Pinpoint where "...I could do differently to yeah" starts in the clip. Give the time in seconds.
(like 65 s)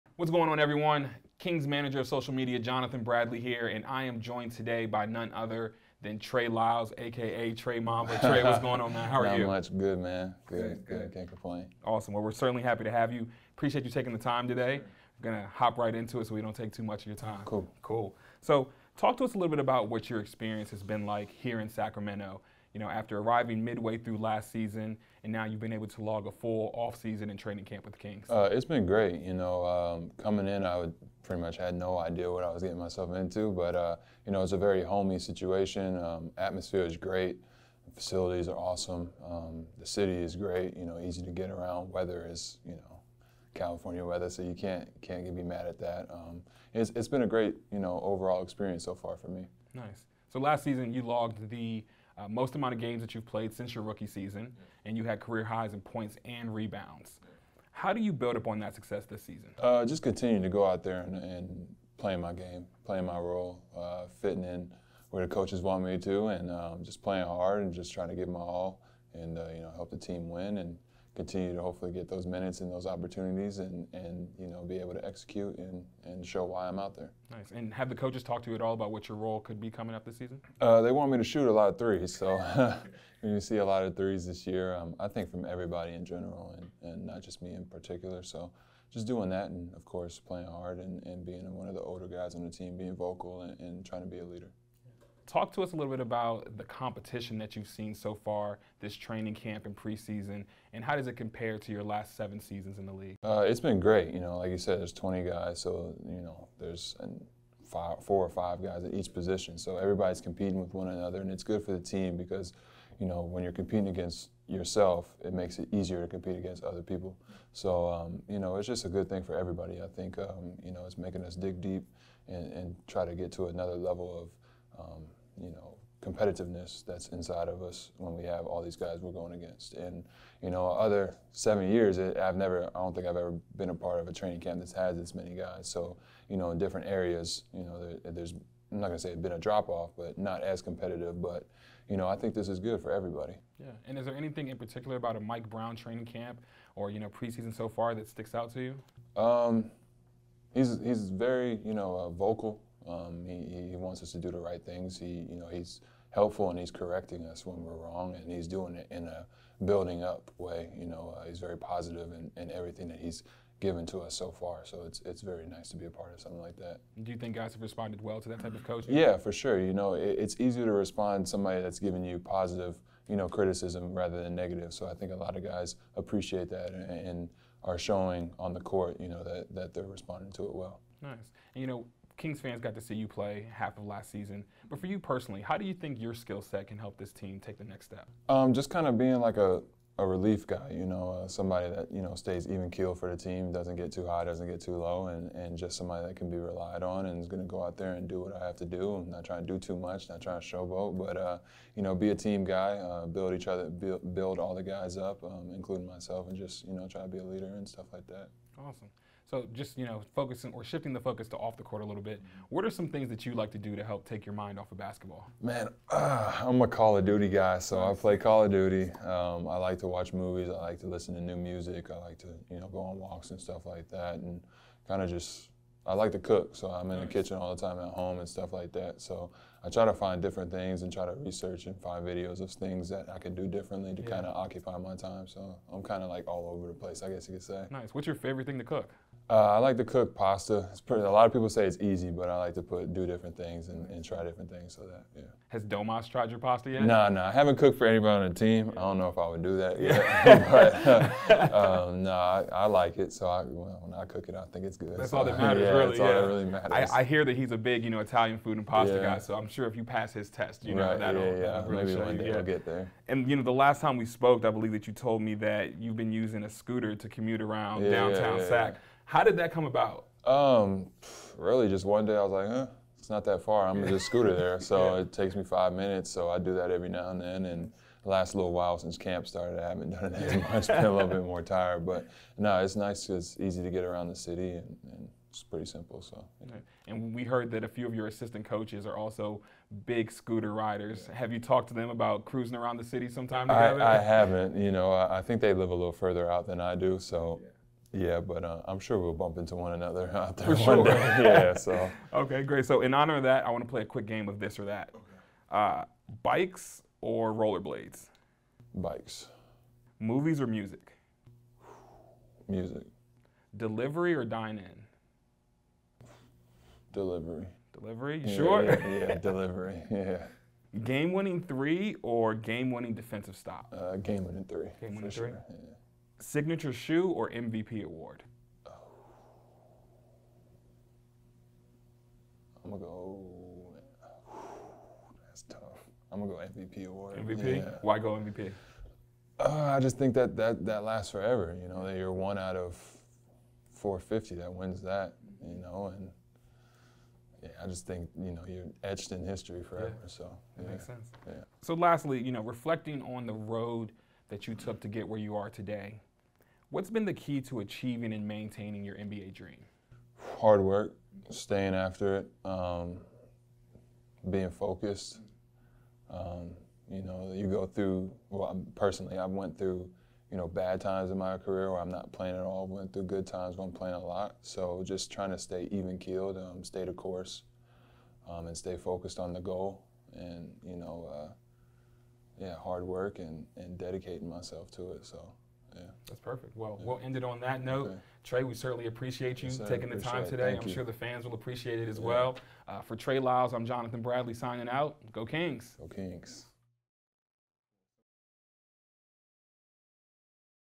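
233 s.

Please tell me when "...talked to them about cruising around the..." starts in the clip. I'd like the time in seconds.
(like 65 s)
291 s.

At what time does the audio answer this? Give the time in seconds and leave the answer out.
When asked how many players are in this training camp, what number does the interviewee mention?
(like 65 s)
104 s.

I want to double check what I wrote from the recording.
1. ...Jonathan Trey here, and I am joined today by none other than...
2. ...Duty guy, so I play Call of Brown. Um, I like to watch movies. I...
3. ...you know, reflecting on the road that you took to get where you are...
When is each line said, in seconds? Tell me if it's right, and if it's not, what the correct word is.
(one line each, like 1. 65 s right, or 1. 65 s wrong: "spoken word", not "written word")
1. 2 s wrong: "Bradley", not "Trey"
2. 217 s wrong: "Duty", not "Brown"
3. 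352 s right.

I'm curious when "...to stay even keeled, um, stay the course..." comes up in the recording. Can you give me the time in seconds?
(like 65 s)
375 s.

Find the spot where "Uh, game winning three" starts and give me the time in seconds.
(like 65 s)
323 s.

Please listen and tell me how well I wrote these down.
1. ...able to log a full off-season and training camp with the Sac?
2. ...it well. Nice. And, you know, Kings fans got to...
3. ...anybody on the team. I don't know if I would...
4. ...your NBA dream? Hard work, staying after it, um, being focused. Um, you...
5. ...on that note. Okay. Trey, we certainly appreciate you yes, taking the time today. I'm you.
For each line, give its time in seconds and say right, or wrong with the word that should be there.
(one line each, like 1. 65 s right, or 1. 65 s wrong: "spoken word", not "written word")
1. 25 s wrong: "Kings", not "Sac"
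2. 180 s right
3. 247 s right
4. 358 s right
5. 387 s right.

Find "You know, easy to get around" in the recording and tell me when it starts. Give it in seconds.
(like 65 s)
40 s.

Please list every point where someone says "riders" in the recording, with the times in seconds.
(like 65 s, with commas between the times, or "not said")
290 s.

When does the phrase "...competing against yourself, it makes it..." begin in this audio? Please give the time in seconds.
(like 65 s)
113 s.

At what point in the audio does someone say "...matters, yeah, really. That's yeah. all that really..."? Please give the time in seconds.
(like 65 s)
255 s.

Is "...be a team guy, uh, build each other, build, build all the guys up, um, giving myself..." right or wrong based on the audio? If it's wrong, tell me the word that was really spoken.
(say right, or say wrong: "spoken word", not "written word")
wrong: "including", not "giving".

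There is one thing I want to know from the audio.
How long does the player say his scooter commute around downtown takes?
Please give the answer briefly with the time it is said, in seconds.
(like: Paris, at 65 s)
5 minutes, at 275 s.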